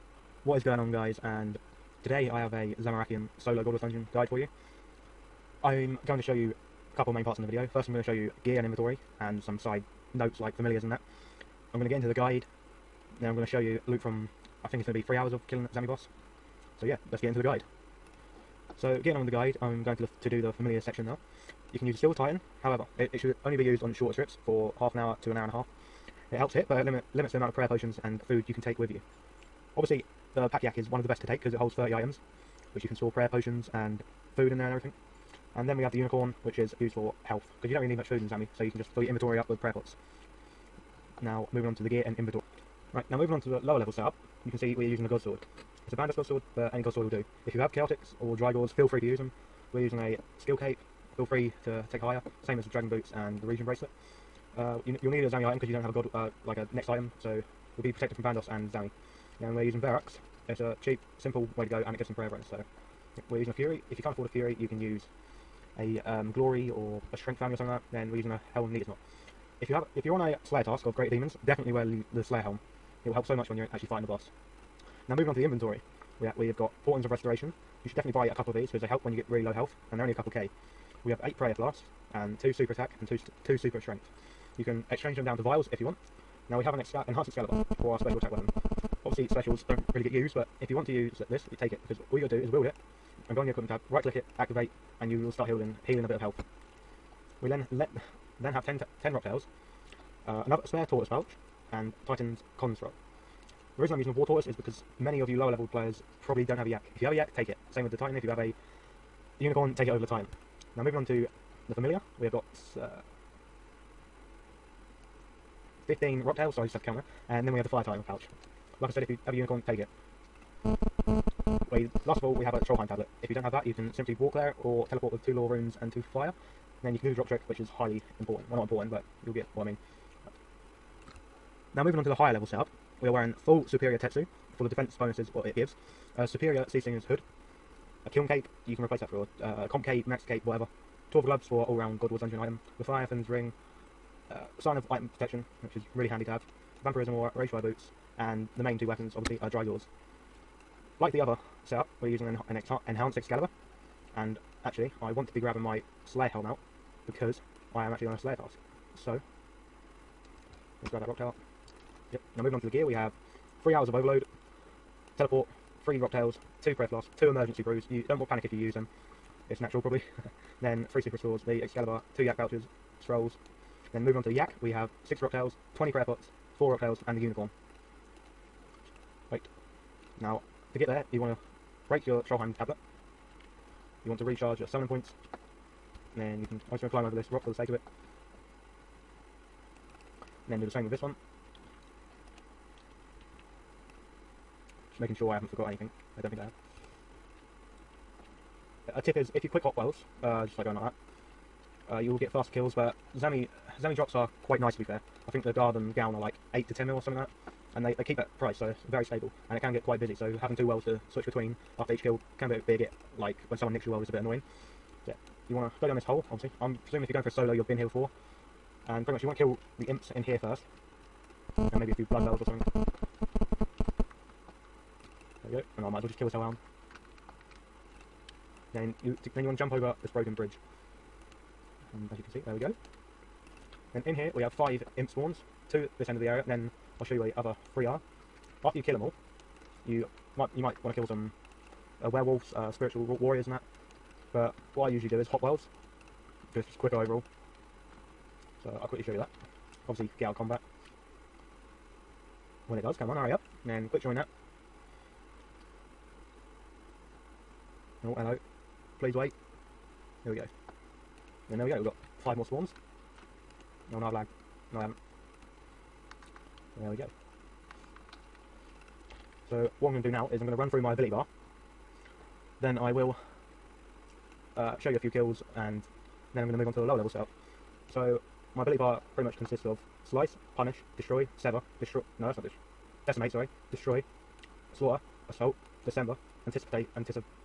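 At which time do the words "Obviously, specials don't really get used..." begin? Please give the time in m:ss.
1:29.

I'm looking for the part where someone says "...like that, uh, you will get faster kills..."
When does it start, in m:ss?
3:20.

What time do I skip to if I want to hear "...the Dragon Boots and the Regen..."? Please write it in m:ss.
0:52.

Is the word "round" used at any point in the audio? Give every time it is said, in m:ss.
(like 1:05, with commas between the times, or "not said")
2:21.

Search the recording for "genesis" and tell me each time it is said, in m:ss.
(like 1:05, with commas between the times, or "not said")
not said.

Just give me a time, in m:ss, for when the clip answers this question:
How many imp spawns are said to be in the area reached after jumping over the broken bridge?
3:54.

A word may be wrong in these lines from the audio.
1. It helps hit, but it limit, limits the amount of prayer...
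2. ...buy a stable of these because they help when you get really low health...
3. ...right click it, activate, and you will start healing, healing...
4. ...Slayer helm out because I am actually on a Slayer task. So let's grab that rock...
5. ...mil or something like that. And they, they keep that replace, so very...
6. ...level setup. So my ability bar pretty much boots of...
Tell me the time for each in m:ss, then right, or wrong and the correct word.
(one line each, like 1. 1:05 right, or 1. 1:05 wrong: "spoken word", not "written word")
1. 0:26 right
2. 1:18 wrong: "couple", not "stable"
3. 1:33 right
4. 2:36 right
5. 3:26 wrong: "price", not "replace"
6. 4:36 wrong: "consists", not "boots".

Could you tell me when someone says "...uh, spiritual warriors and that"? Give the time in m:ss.
4:02.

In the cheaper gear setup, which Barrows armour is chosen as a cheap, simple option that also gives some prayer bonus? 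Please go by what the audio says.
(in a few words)
Verac's.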